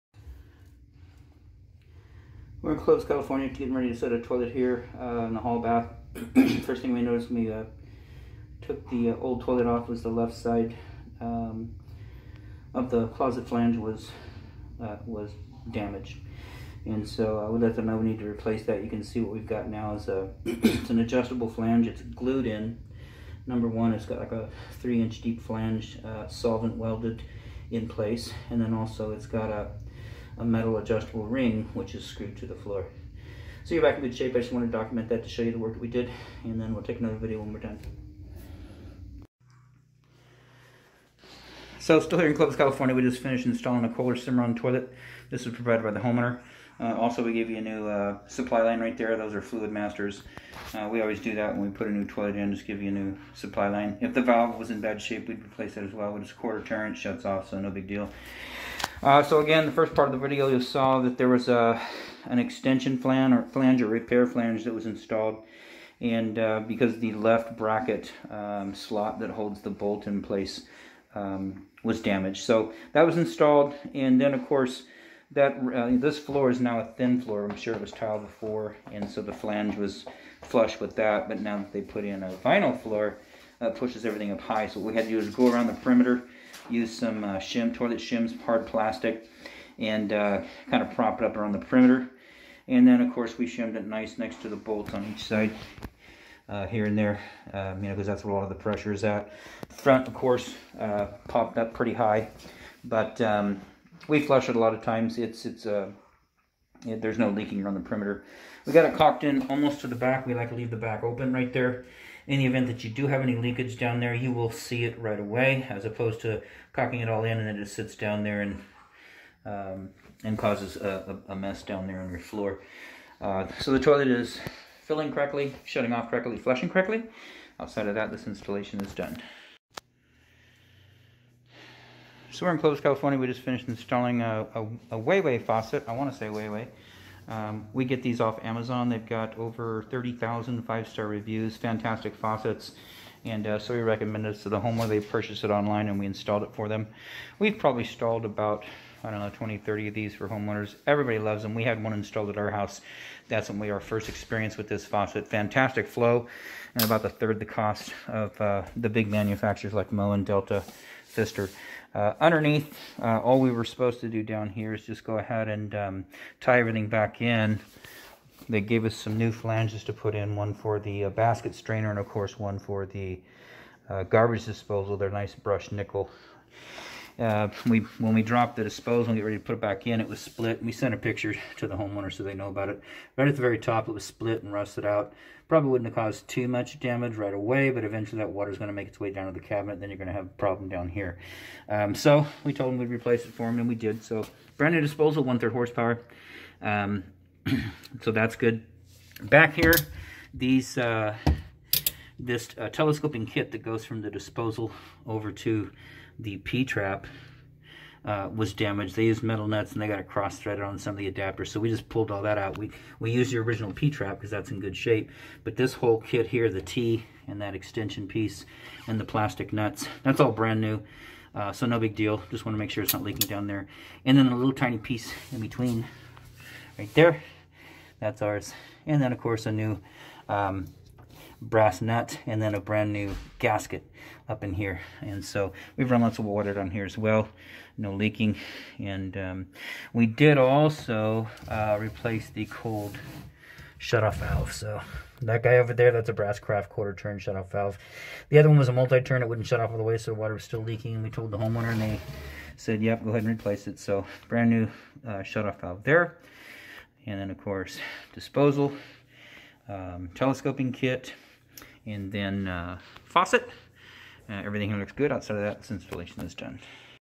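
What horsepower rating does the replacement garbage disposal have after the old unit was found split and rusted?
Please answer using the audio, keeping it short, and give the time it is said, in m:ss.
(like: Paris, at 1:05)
1/3 horsepower, at 3:15.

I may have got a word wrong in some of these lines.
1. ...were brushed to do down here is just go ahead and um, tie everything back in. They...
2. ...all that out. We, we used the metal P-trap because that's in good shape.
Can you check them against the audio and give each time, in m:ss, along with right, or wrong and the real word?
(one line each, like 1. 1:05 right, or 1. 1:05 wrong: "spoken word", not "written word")
1. 2:43 wrong: "supposed", not "brushed"
2. 3:32 wrong: "original", not "metal".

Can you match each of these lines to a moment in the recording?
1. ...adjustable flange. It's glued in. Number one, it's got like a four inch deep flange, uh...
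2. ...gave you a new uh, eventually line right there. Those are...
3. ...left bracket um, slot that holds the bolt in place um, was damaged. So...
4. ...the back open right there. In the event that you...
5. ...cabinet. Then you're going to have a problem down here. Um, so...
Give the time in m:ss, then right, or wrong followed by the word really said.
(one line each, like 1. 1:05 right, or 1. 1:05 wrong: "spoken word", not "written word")
1. 0:20 wrong: "three", not "four"
2. 0:47 wrong: "supply", not "eventually"
3. 1:07 right
4. 1:50 right
5. 3:09 right.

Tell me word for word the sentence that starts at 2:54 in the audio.
They're nice brushed nickel uh, we when we dropped the disposal and get ready to put it back in, it was split.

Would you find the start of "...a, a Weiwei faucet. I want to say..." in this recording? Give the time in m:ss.
2:14.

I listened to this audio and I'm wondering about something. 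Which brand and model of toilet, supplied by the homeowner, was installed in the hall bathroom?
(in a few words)
Kohler Cimarron.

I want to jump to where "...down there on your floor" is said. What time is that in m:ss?
2:01.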